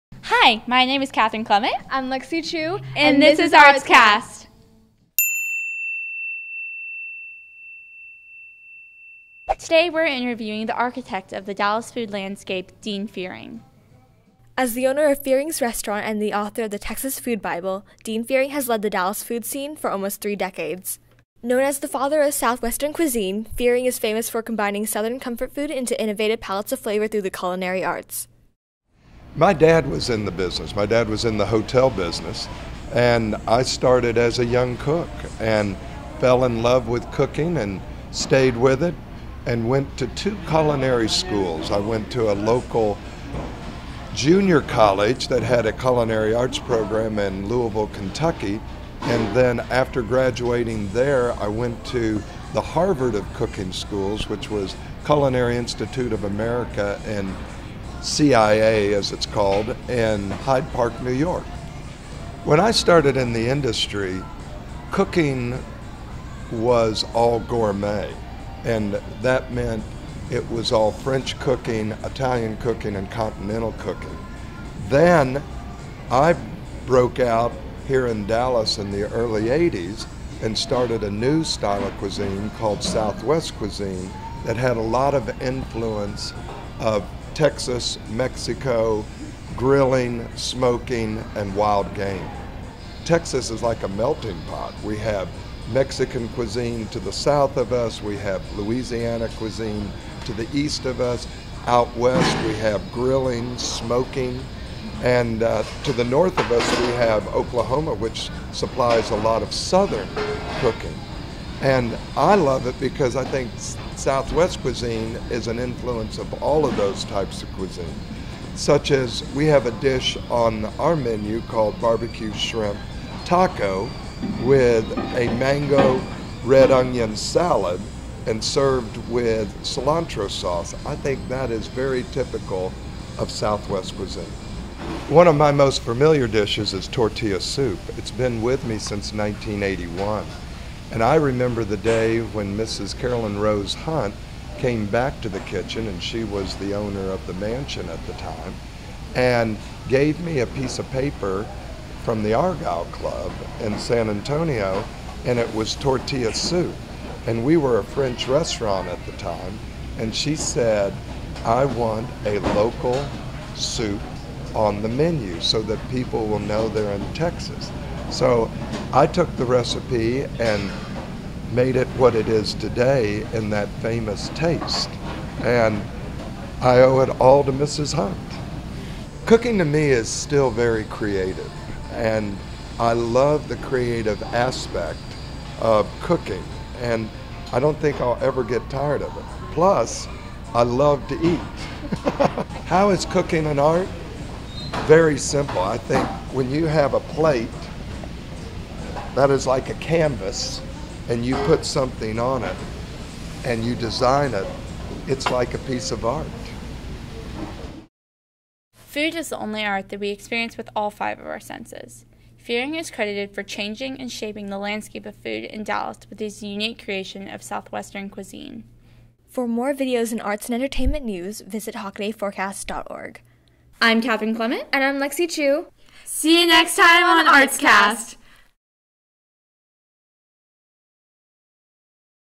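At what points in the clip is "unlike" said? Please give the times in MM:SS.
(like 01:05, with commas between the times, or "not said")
not said.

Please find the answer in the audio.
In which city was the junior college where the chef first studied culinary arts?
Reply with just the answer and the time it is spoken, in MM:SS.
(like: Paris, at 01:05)
Louisville, Kentucky, at 00:47.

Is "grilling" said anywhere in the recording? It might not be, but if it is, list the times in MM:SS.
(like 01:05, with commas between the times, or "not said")
01:29, 01:42.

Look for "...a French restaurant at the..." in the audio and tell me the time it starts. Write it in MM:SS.
02:37.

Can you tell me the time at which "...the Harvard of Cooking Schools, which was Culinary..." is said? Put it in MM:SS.
00:52.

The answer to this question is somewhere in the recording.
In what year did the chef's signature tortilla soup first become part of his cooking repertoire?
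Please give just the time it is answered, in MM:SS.
02:19.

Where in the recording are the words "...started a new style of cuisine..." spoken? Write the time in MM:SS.
01:20.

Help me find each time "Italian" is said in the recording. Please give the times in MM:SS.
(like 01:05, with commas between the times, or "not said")
01:12.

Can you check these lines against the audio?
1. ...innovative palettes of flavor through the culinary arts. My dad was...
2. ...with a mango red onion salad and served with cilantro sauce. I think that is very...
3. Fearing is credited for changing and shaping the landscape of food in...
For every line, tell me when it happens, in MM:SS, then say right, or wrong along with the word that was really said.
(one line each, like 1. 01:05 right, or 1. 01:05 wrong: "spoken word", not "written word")
1. 00:26 right
2. 02:04 right
3. 03:32 right.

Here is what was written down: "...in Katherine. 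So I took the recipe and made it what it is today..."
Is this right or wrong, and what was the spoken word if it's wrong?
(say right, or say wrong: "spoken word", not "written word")
wrong: "Texas", not "Katherine".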